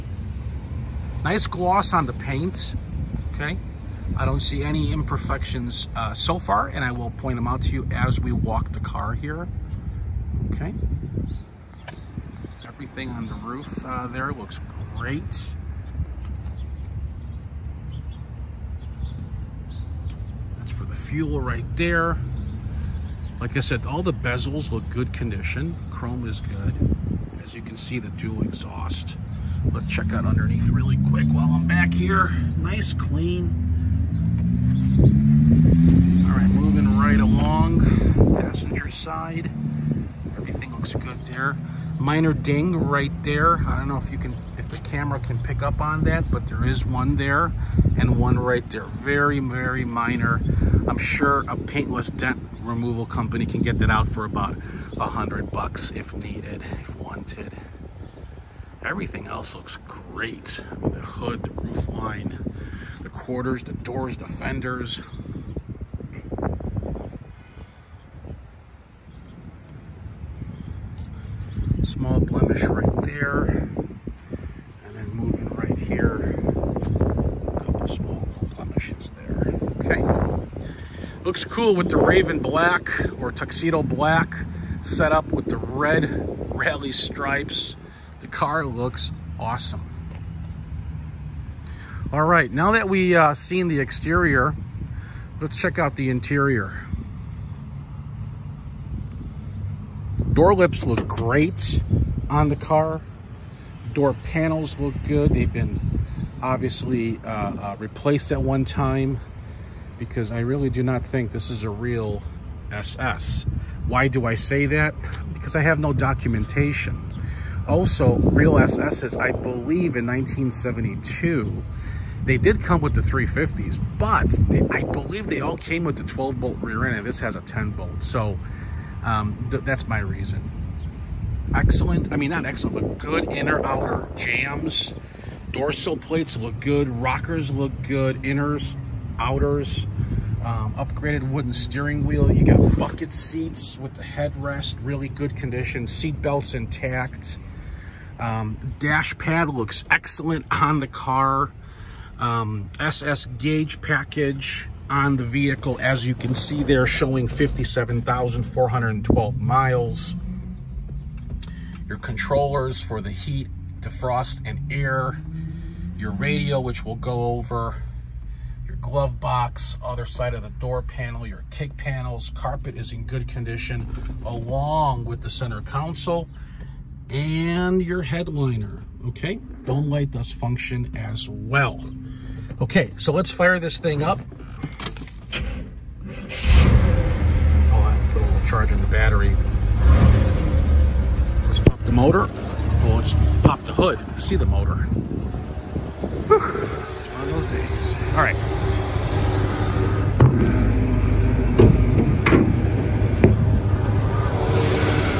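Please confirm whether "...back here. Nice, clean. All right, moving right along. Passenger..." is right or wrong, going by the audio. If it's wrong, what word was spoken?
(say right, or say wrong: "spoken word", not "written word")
right.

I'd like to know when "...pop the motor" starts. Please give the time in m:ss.
3:11.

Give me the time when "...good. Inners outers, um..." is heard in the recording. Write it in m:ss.
2:17.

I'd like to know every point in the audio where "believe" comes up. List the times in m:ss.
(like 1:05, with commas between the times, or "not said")
1:59, 2:04.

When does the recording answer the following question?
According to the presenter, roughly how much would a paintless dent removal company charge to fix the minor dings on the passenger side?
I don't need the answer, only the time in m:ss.
0:54.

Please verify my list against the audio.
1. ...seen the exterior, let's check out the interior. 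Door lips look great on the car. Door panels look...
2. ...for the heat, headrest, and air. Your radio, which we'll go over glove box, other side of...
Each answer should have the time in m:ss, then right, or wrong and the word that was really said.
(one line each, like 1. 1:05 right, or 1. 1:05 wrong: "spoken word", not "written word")
1. 1:33 right
2. 2:42 wrong: "defrost", not "headrest".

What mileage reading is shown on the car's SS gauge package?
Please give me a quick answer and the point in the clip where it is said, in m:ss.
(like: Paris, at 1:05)
57,412, at 2:37.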